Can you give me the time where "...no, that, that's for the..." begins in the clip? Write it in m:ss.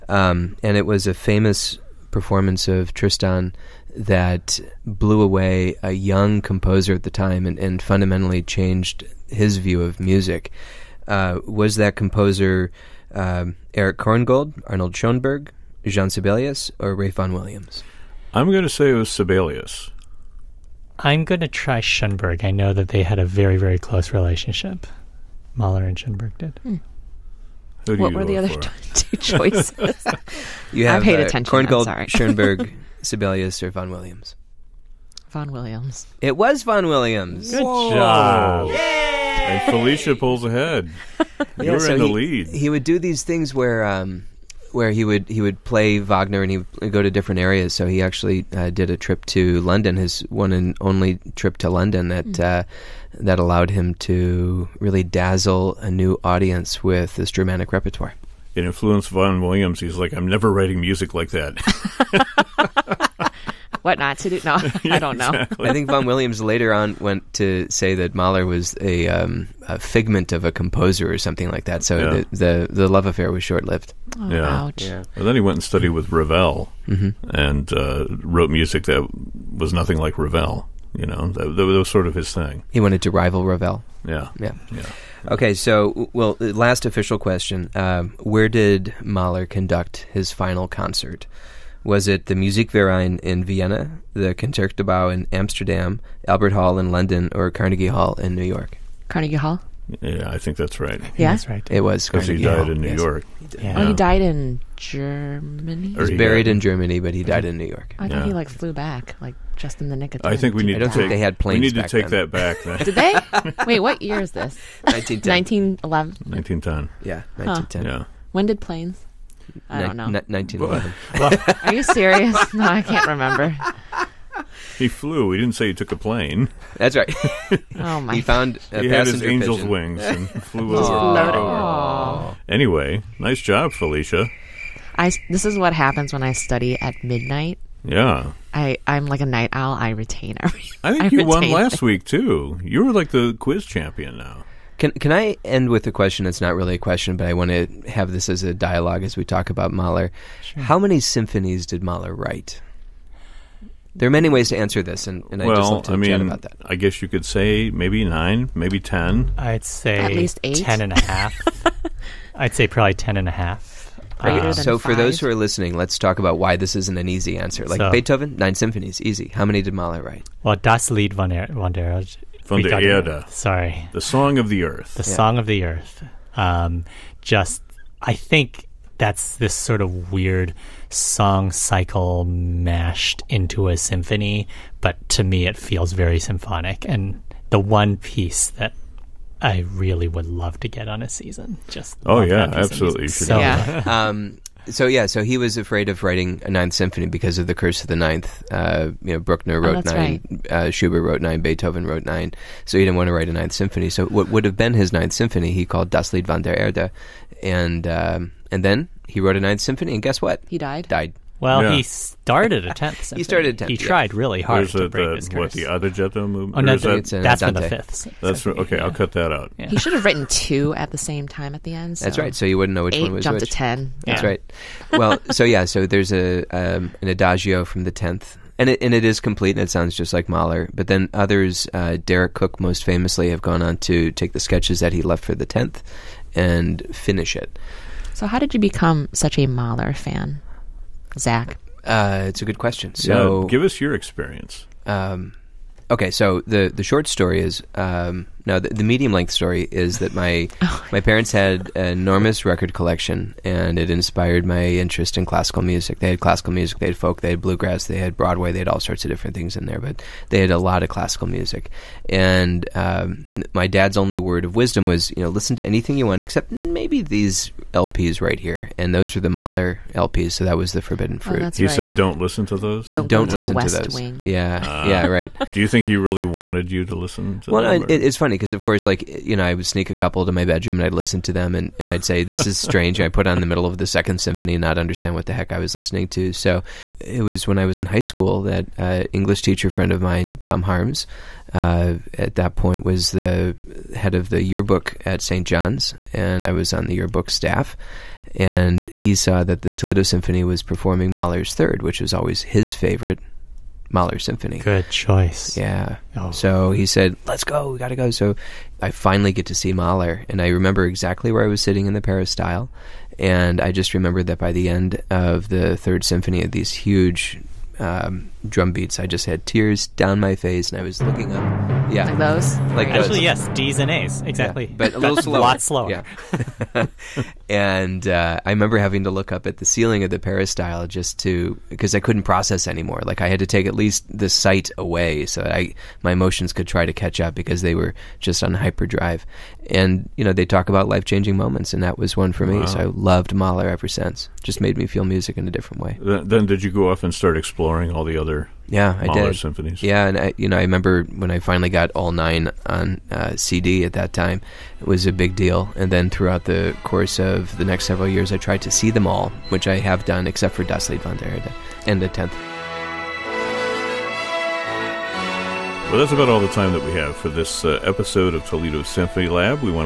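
3:36.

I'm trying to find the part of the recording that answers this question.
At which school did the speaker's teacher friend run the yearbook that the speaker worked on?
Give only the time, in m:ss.
4:55.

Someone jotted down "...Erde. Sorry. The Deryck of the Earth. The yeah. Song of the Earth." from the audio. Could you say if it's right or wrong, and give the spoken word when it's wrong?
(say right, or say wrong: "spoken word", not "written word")
wrong: "Song", not "Deryck".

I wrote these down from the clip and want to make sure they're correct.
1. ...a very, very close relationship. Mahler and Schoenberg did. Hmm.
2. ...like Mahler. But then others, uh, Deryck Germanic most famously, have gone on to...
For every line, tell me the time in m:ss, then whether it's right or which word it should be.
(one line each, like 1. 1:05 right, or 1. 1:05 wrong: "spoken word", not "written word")
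1. 0:23 right
2. 3:50 wrong: "Cooke", not "Germanic".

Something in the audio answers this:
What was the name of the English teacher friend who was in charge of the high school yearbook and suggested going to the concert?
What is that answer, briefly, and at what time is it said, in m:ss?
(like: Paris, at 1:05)
Tom Harms, at 4:50.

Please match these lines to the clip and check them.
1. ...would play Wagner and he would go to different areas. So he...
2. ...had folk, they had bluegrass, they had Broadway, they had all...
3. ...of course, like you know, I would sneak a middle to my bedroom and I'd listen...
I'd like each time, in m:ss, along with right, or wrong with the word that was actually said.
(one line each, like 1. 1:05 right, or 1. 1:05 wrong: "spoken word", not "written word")
1. 0:45 right
2. 4:16 right
3. 4:38 wrong: "couple", not "middle".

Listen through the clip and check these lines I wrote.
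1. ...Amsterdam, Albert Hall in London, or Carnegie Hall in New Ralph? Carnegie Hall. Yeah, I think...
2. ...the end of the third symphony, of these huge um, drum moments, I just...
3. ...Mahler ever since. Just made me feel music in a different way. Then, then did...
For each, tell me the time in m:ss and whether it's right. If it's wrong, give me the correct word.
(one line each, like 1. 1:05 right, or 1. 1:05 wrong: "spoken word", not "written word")
1. 1:35 wrong: "York", not "Ralph"
2. 5:14 wrong: "beats", not "moments"
3. 5:43 right.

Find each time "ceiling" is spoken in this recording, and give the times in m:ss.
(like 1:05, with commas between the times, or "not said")
5:29.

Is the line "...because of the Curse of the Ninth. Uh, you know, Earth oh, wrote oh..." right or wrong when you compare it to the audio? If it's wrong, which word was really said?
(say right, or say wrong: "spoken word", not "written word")
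wrong: "Bruckner", not "Earth".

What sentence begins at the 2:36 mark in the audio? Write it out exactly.
I guess you could say maybe nine, maybe ten.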